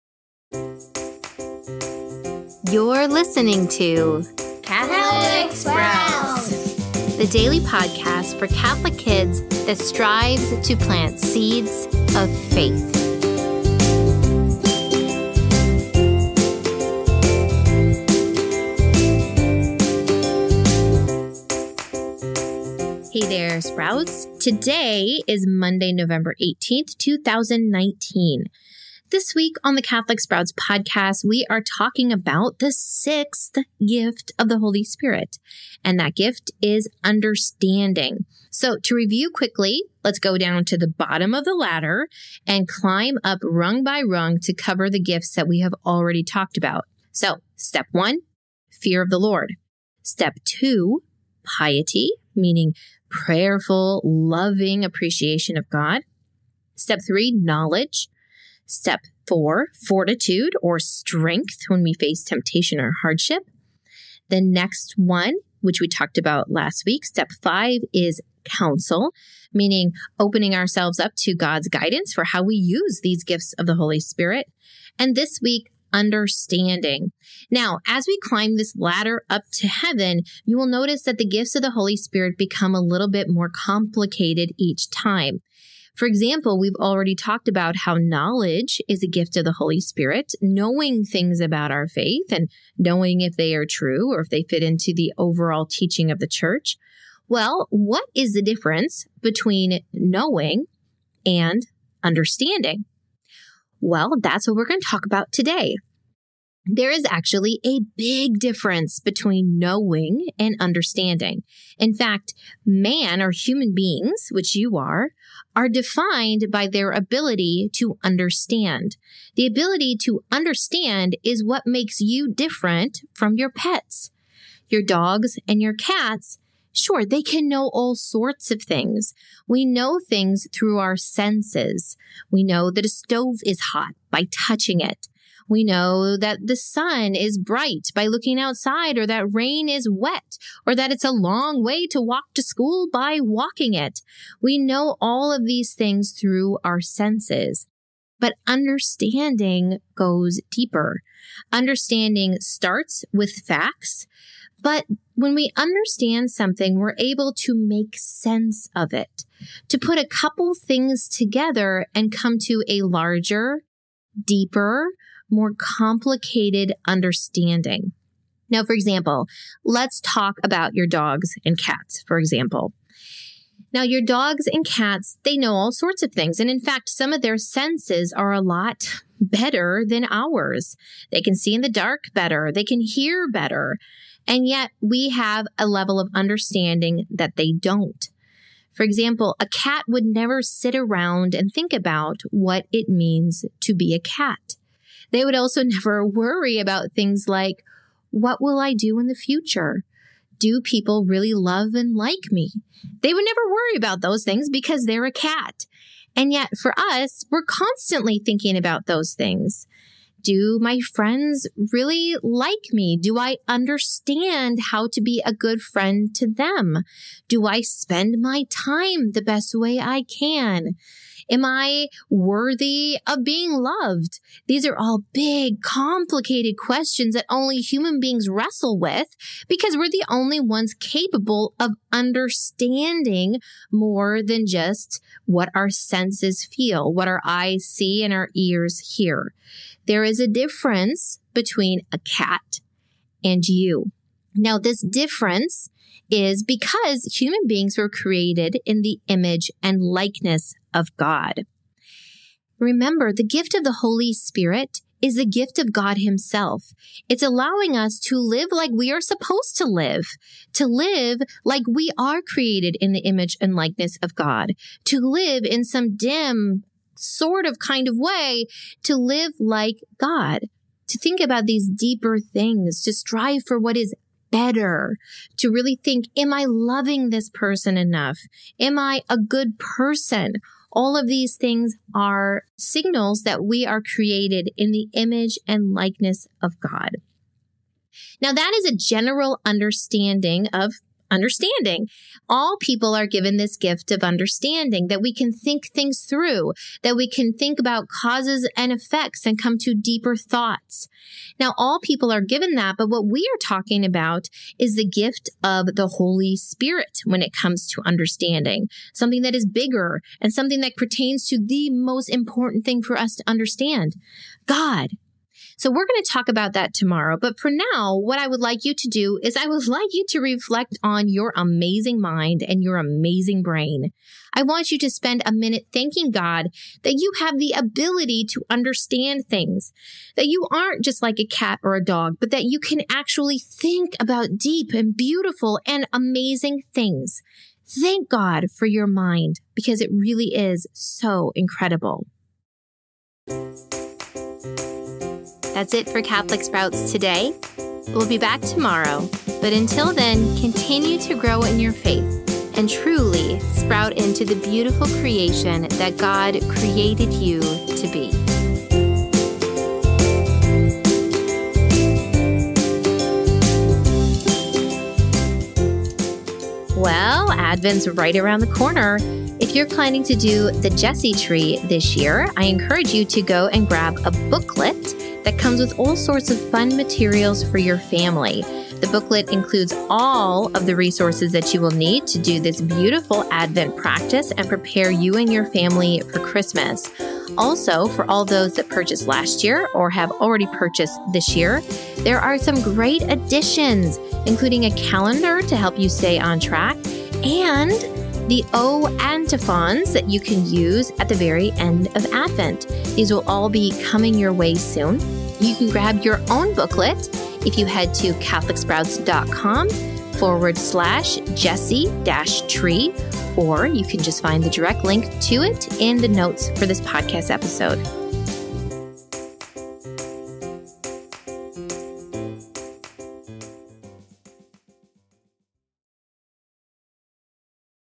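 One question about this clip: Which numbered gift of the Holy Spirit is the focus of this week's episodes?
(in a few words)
sixth.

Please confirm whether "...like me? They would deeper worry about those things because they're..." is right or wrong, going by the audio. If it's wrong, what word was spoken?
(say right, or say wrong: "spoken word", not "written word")
wrong: "never", not "deeper".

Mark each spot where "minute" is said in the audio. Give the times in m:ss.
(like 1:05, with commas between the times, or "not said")
5:25.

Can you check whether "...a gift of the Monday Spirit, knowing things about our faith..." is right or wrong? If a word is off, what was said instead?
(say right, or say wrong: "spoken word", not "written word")
wrong: "Holy", not "Monday".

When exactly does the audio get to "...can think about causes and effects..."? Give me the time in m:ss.
4:57.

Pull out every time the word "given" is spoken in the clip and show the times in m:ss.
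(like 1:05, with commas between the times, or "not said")
4:53, 5:02.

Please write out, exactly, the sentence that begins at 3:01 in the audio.
They can see in the dark better, they can hear better.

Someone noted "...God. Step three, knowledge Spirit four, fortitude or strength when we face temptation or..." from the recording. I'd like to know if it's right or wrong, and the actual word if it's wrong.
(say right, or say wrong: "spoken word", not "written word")
wrong: "Step", not "Spirit".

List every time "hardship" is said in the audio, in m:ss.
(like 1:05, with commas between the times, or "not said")
1:03.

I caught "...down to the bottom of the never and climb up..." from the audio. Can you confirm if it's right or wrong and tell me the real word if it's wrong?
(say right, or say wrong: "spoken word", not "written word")
wrong: "ladder", not "never".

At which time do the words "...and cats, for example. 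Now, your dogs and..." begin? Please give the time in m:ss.
2:51.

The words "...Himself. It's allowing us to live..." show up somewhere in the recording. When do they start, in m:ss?
4:15.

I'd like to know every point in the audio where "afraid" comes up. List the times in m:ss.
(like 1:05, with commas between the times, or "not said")
not said.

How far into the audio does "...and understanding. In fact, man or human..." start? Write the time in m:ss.
1:50.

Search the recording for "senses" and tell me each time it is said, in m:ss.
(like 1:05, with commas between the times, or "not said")
2:10, 2:26, 2:37, 2:57, 3:55.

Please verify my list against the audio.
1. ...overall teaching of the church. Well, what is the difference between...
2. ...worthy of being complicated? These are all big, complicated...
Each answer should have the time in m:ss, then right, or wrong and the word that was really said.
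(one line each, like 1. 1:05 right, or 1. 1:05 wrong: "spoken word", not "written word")
1. 1:35 right
2. 3:42 wrong: "loved", not "complicated".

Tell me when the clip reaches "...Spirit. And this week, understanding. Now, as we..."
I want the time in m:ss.
1:13.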